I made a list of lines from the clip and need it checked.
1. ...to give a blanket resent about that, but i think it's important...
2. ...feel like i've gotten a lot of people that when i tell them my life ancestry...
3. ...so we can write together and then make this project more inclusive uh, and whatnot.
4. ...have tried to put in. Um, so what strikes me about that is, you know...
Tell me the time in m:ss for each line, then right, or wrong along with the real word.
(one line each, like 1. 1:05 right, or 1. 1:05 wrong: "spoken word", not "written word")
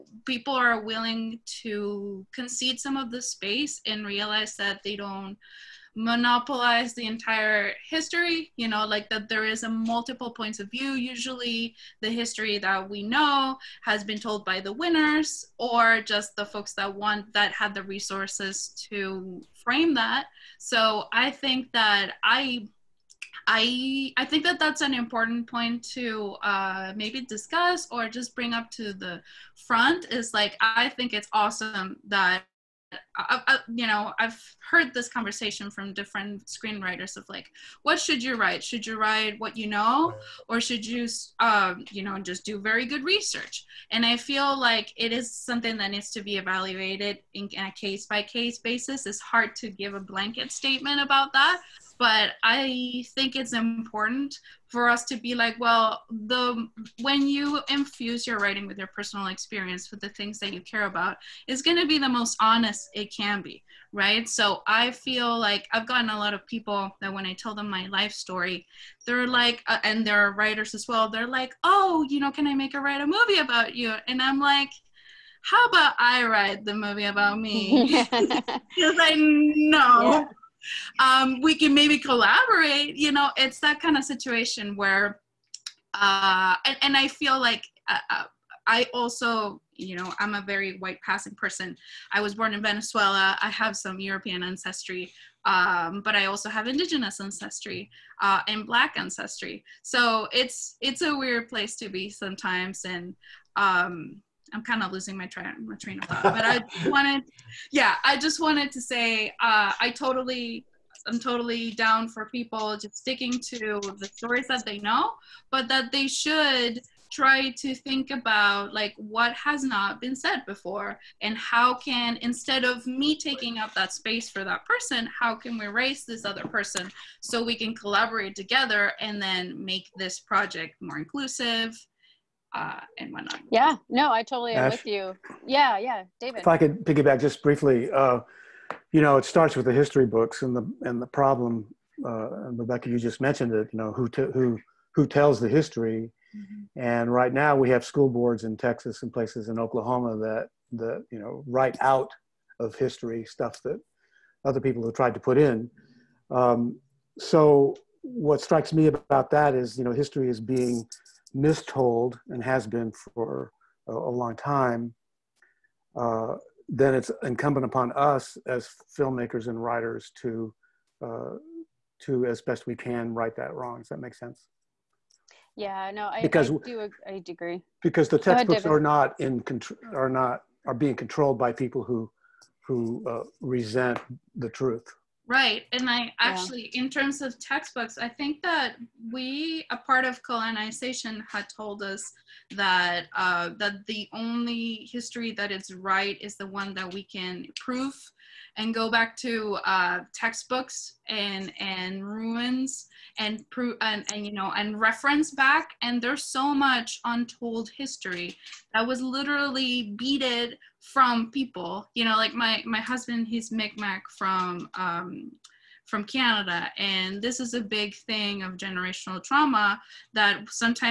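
1. 0:49 wrong: "statement", not "resent"
2. 1:04 wrong: "story", not "ancestry"
3. 2:07 wrong: "collaborate", not "write"
4. 2:34 right.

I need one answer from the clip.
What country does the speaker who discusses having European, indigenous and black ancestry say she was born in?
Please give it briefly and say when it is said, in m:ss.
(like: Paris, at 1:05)
Venezuela, at 1:32.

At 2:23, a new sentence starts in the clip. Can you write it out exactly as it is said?
You know, who t- who who tells the history?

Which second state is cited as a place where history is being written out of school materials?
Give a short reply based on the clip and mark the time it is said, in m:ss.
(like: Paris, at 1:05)
Oklahoma, at 2:29.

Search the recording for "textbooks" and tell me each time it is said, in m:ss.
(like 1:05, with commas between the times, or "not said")
2:58, 3:07, 3:20.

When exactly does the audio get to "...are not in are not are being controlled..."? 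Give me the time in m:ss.
2:58.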